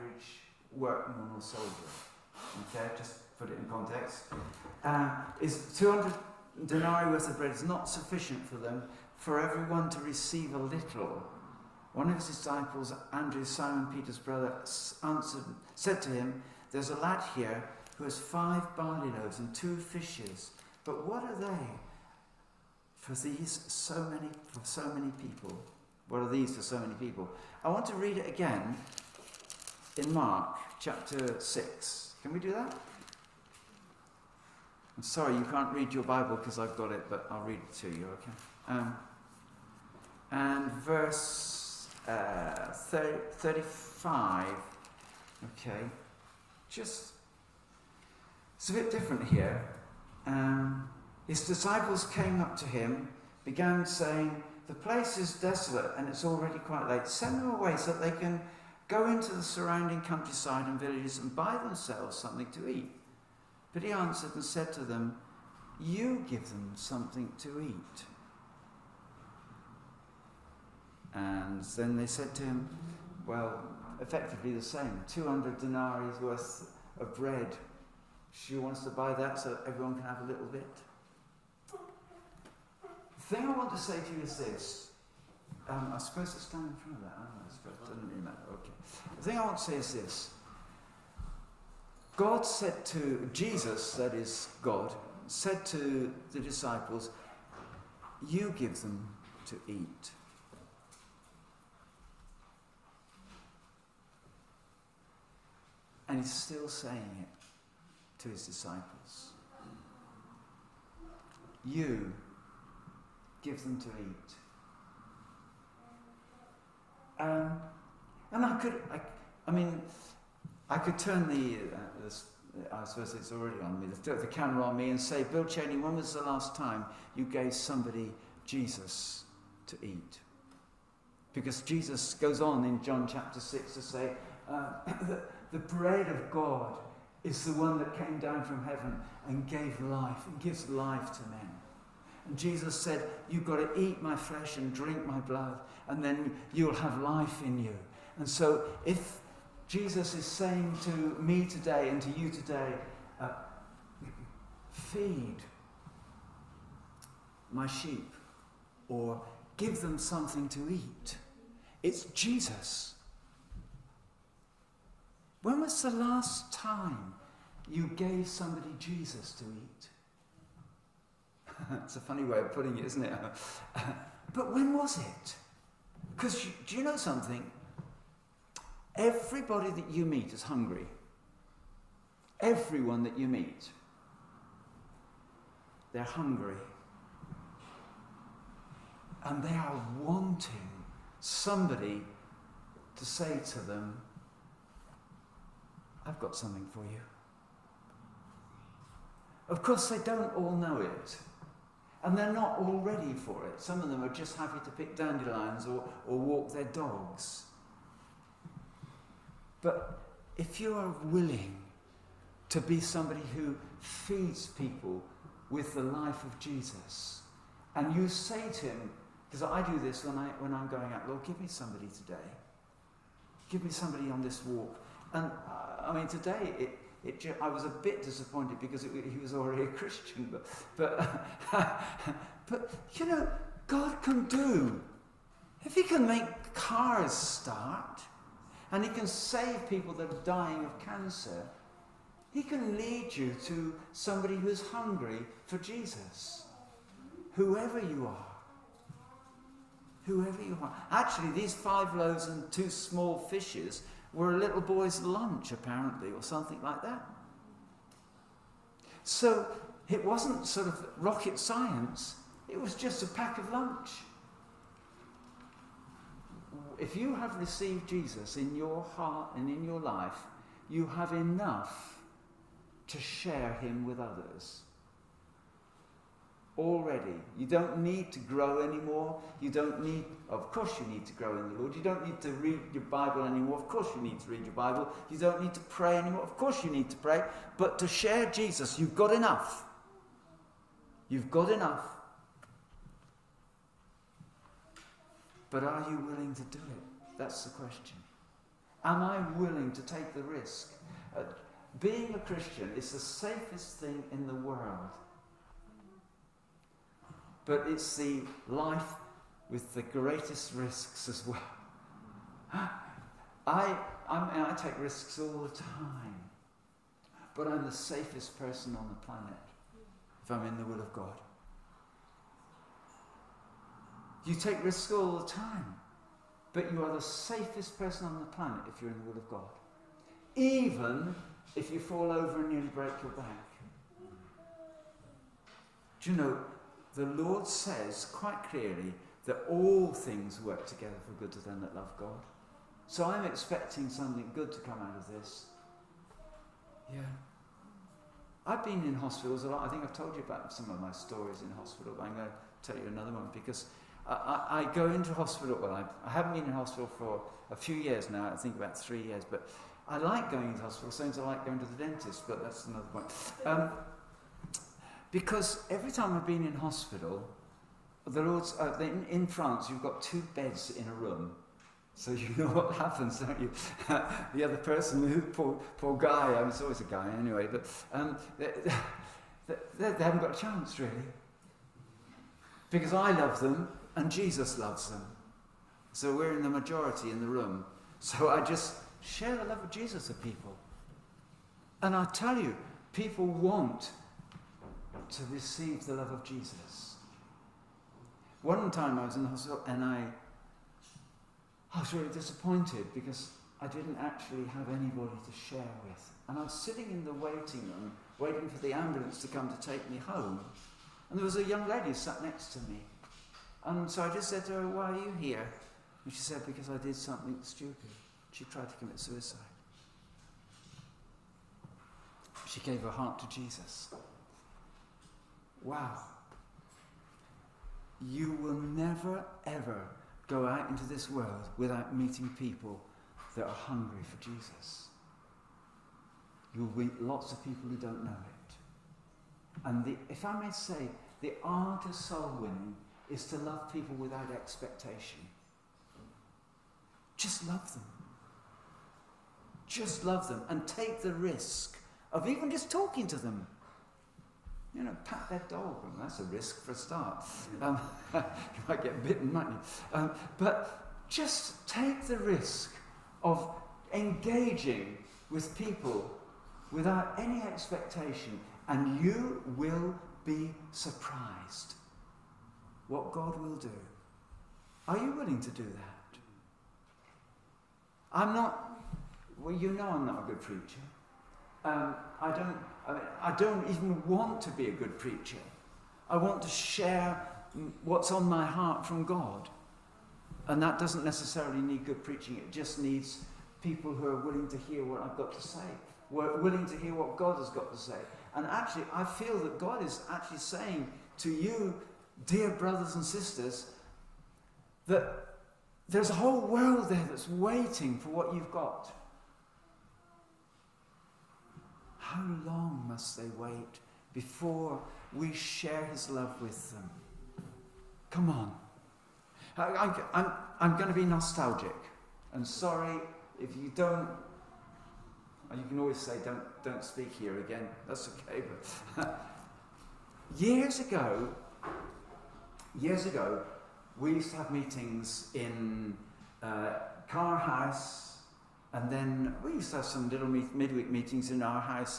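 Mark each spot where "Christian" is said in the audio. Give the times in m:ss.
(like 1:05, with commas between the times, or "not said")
3:49, 5:02.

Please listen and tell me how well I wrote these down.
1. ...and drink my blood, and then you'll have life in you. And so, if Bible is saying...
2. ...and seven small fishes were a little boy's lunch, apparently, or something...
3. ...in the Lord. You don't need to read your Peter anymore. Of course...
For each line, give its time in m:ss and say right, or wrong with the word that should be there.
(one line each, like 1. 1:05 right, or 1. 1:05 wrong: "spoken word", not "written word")
1. 2:24 wrong: "Jesus", not "Bible"
2. 4:12 wrong: "two", not "seven"
3. 4:41 wrong: "Bible", not "Peter".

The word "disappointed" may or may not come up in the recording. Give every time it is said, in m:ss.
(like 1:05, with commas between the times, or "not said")
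3:48, 6:42.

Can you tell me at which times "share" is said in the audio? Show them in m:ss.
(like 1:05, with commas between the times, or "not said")
4:32, 4:47, 6:29, 6:45, 8:06, 8:35.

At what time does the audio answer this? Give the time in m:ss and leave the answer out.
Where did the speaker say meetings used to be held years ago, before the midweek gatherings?
8:57.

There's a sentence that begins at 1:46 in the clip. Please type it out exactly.
And he's still saying it to his disciples.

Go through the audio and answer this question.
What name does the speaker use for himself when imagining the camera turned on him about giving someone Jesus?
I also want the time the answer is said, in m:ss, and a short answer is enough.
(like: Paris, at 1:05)
Bill Chaney, at 2:05.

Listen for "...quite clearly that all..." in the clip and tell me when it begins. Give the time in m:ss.
5:38.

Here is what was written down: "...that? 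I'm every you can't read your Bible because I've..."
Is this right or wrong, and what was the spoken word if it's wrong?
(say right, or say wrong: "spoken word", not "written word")
wrong: "sorry", not "every".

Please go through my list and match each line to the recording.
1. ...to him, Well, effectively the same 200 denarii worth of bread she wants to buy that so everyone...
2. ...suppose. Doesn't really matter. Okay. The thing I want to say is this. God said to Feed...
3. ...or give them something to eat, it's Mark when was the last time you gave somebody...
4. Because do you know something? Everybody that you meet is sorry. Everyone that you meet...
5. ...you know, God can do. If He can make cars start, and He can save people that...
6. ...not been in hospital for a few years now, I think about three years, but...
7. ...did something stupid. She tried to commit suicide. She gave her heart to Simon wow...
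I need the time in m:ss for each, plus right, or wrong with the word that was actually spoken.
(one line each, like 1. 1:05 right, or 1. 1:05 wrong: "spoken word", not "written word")
1. 1:12 right
2. 1:27 wrong: "Jesus", not "Feed"
3. 2:38 wrong: "Jesus", not "Mark"
4. 2:56 wrong: "hungry", not "sorry"
5. 3:52 right
6. 5:56 right
7. 6:56 wrong: "Jesus", not "Simon".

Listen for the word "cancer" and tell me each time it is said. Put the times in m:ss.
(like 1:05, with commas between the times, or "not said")
4:00.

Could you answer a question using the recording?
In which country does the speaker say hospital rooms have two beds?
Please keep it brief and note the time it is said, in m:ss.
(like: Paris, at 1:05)
France, at 6:09.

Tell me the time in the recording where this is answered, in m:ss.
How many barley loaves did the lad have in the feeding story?
0:18.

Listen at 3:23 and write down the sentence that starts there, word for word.
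Some of them are just happy to pick dandelions or, or walk their dogs.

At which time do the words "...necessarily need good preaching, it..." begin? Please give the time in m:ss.
8:11.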